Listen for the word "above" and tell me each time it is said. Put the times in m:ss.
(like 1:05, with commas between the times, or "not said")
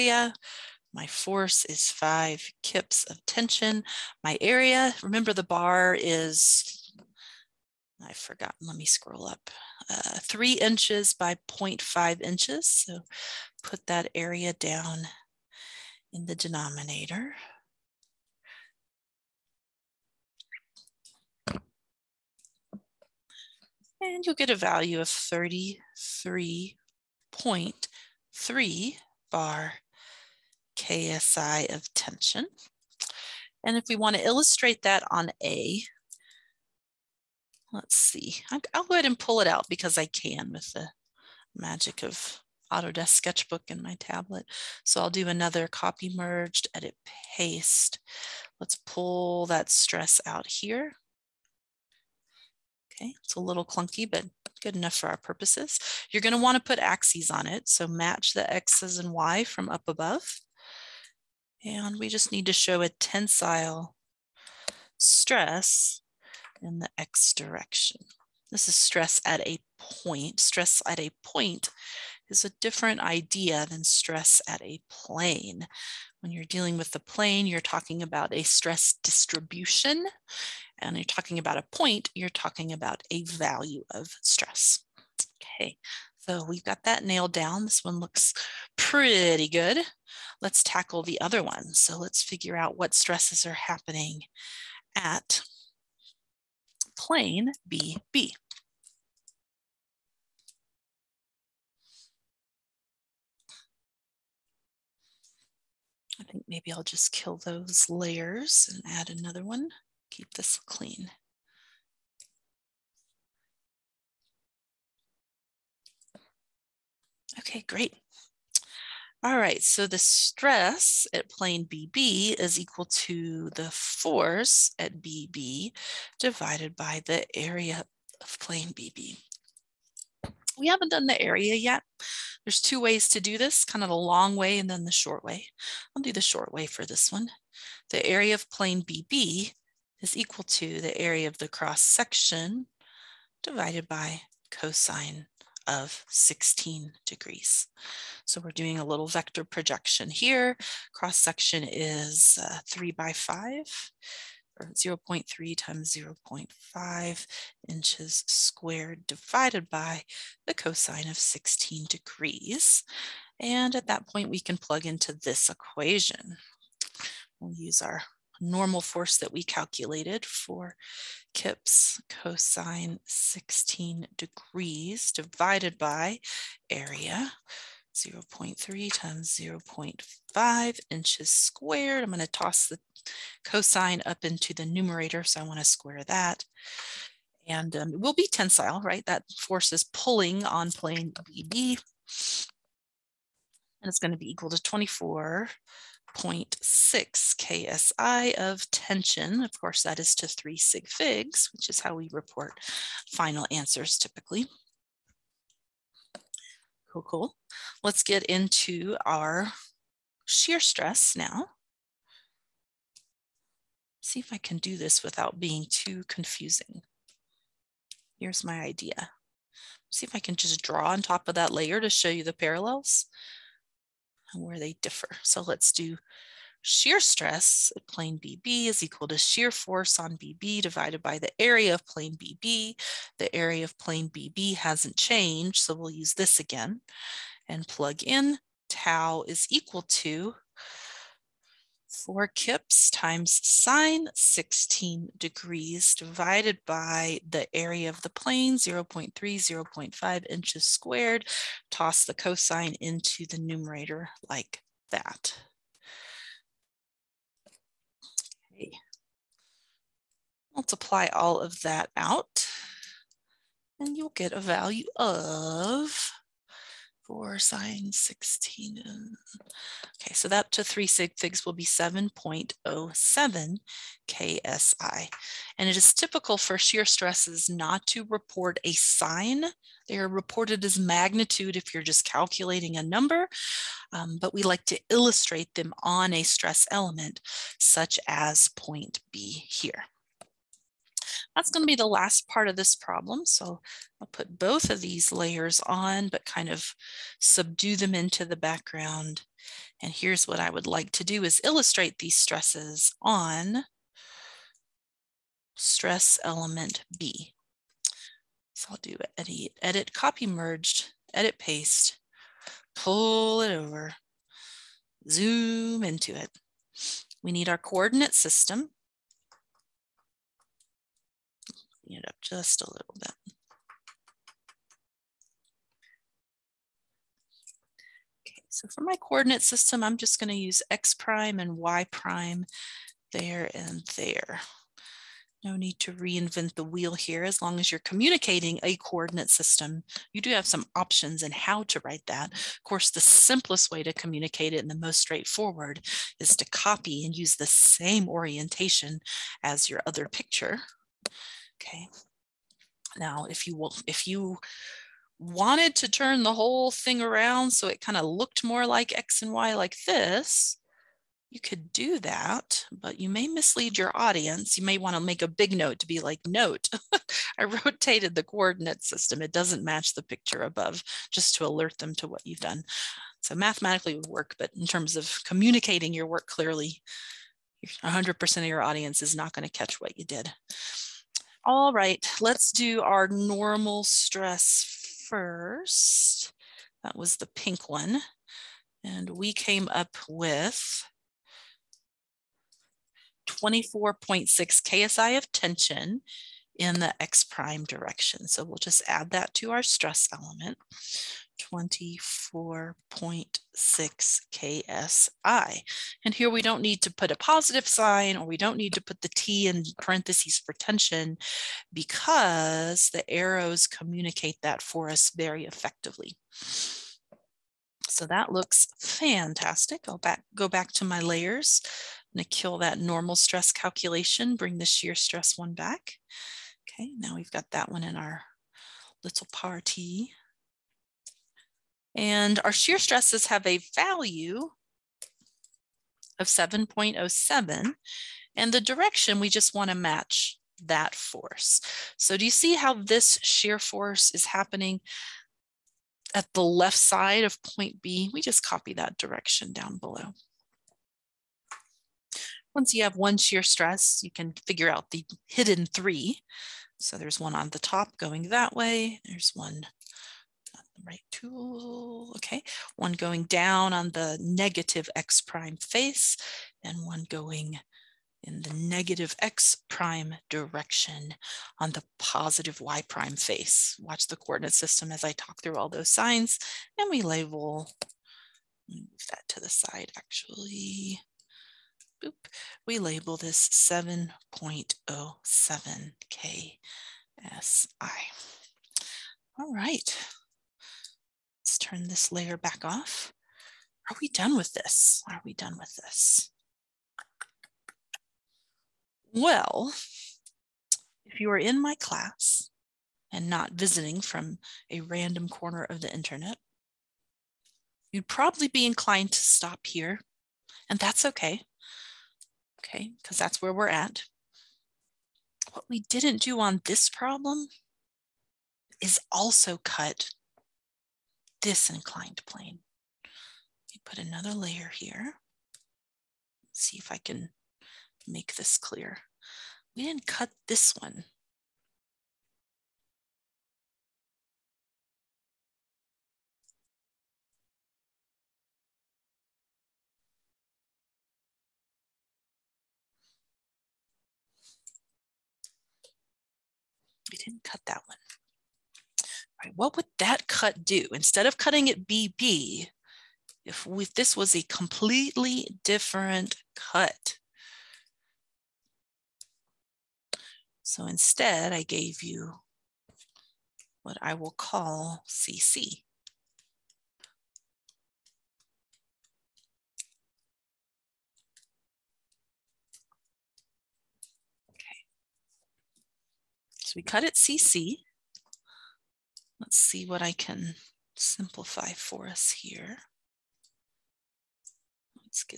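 0:59, 6:10.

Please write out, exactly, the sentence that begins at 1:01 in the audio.
And we just need to show a tensile stress in the X direction.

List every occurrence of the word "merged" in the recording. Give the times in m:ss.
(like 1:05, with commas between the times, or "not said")
0:46, 5:10.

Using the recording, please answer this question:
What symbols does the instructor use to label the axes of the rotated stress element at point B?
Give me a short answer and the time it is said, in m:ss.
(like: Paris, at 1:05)
x prime and y prime, at 5:30.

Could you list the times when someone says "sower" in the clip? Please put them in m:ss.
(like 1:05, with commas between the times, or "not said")
not said.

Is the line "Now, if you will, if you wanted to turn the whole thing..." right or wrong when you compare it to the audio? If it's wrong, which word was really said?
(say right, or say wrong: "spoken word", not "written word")
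right.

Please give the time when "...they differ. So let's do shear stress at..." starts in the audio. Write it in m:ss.
3:44.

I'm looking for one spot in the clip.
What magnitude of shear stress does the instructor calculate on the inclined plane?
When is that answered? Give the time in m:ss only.
4:31.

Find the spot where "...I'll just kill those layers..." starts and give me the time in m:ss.
1:46.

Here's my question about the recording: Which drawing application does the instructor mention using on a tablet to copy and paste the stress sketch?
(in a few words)
Autodesk Sketchbook.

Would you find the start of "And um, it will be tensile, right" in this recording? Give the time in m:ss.
3:07.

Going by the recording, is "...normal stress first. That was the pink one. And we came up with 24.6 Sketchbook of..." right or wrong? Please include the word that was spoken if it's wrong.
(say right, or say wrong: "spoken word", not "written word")
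wrong: "KSI", not "Sketchbook".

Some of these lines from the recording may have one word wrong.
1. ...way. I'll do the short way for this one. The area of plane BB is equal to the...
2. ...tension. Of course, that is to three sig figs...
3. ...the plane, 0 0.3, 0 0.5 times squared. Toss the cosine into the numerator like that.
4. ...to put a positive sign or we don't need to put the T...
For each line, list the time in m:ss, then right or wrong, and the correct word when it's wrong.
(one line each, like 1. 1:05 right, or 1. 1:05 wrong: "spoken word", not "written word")
1. 2:15 right
2. 3:18 right
3. 4:08 wrong: "inches", not "times"
4. 6:46 right.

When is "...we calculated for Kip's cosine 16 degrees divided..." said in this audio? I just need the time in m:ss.
2:49.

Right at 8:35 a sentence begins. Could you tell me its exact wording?
What we didn't do on this problem is also cut this inclined plane.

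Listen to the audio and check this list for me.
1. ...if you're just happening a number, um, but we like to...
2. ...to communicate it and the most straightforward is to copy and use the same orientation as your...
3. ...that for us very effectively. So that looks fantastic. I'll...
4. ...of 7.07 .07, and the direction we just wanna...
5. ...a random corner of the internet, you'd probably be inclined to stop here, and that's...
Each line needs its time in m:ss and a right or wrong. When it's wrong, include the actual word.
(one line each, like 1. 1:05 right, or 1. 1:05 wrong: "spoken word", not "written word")
1. 4:41 wrong: "calculating", not "happening"
2. 5:43 right
3. 6:54 right
4. 7:16 right
5. 8:24 right.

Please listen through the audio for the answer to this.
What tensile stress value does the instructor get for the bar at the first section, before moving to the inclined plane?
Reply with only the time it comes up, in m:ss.
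0:25.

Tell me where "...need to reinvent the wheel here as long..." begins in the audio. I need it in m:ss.
5:35.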